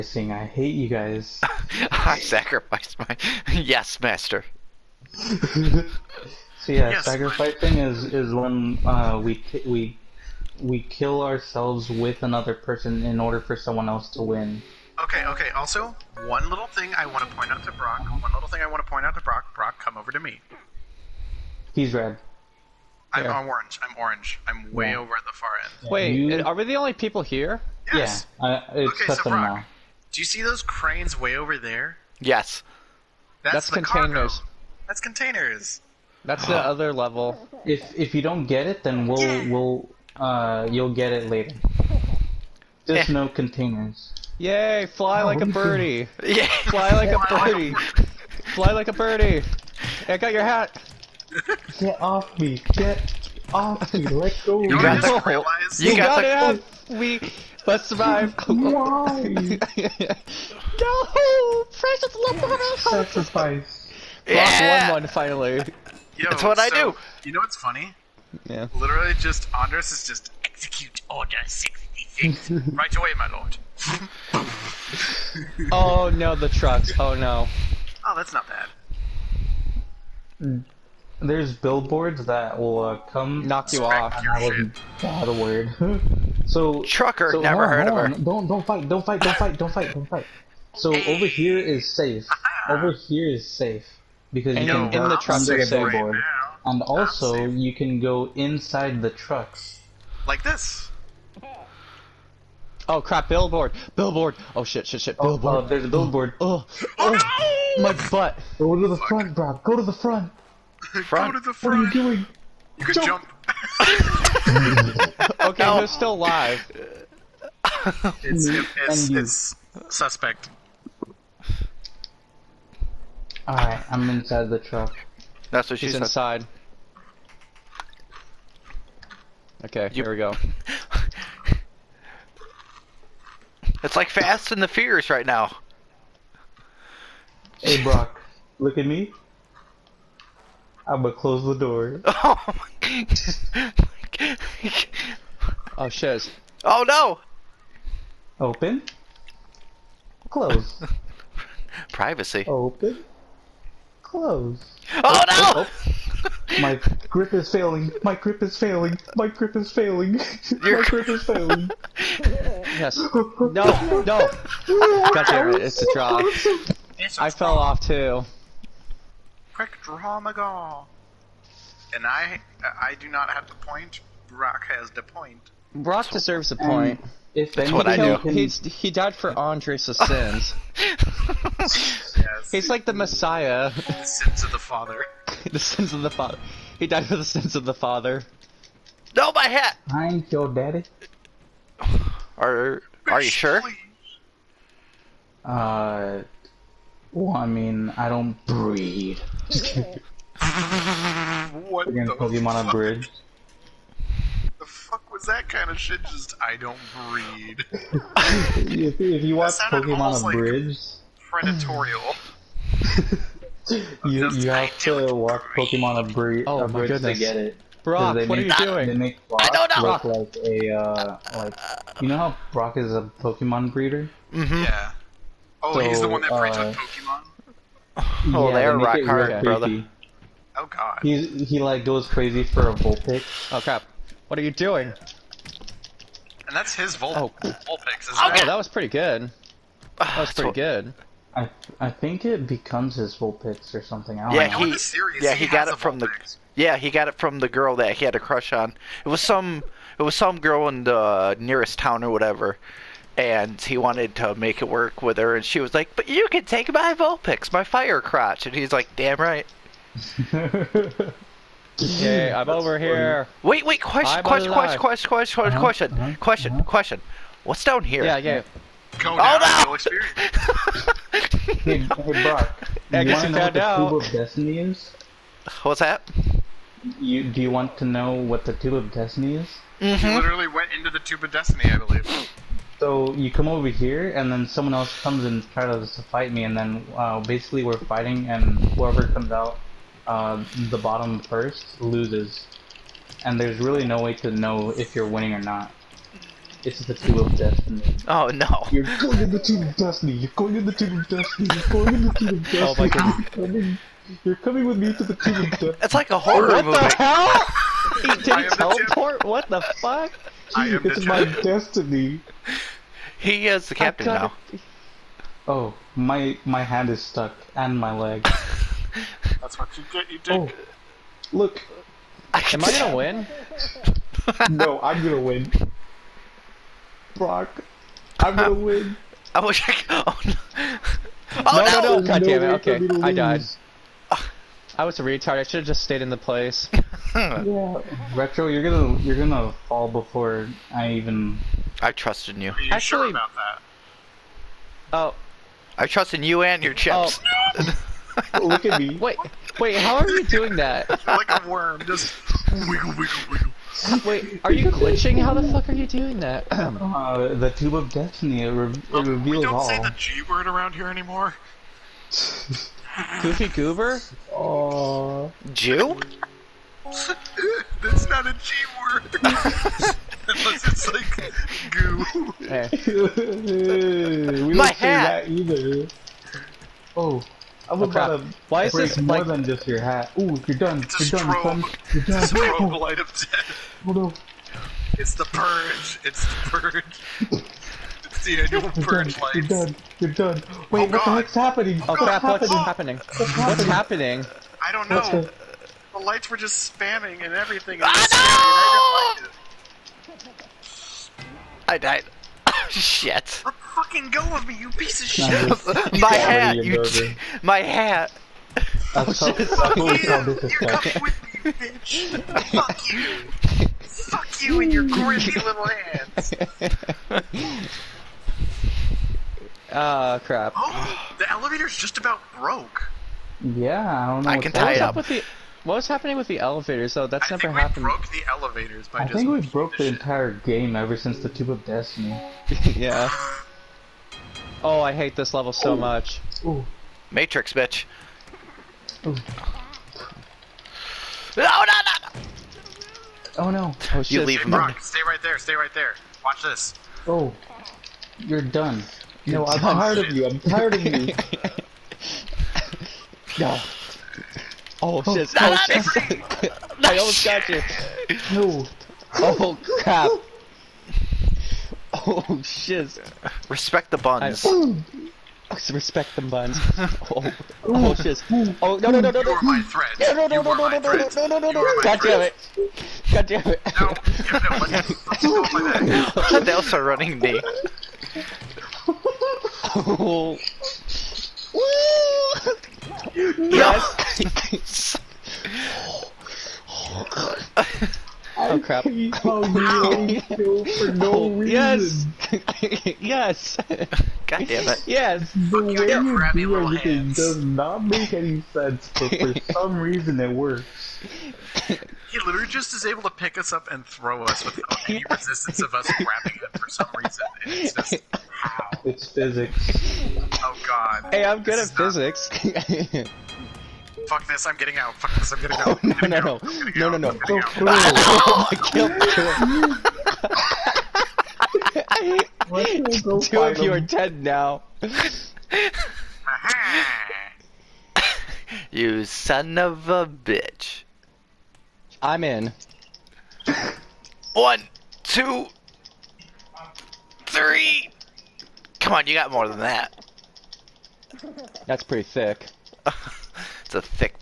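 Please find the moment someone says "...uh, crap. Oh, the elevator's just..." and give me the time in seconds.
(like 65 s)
420 s.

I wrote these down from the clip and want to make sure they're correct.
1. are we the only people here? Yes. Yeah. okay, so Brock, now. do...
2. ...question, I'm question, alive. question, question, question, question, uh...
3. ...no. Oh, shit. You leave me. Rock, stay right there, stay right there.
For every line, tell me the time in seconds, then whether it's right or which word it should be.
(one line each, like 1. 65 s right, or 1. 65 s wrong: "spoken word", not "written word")
1. 26 s right
2. 263 s right
3. 443 s right.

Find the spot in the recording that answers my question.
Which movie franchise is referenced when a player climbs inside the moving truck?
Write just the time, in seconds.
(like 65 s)
134 s.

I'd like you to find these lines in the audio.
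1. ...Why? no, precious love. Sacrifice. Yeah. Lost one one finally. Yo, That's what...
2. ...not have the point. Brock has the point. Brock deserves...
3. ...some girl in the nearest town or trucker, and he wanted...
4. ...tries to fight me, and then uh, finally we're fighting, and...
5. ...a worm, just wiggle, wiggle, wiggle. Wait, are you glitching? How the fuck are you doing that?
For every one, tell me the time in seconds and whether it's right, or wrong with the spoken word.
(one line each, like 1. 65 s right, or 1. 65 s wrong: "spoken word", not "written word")
1. 58 s right
2. 173 s right
3. 250 s wrong: "whatever", not "trucker"
4. 285 s wrong: "basically", not "finally"
5. 351 s right.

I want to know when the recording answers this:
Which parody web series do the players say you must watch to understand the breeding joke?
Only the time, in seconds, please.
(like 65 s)
209 s.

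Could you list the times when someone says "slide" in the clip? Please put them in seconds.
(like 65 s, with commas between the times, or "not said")
not said.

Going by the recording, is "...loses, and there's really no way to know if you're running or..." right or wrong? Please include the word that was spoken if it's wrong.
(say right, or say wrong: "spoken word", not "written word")
wrong: "winning", not "running".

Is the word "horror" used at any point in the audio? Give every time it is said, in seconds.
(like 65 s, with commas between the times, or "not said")
306 s.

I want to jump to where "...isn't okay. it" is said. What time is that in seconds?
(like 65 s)
238 s.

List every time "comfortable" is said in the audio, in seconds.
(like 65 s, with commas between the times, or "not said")
not said.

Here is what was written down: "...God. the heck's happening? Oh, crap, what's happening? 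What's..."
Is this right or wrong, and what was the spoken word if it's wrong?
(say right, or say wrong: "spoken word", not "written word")
right.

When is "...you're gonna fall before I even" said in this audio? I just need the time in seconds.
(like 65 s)
338 s.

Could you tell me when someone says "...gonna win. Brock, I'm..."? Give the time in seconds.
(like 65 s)
325 s.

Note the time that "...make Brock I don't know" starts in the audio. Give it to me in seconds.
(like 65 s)
218 s.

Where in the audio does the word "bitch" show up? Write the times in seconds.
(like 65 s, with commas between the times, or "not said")
411 s, 437 s, 530 s.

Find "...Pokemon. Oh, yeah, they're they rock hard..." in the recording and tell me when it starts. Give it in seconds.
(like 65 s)
226 s.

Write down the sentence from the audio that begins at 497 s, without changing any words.
does not make any sense, but for some reason it works.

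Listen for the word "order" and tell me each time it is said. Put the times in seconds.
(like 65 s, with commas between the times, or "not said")
13 s, 71 s.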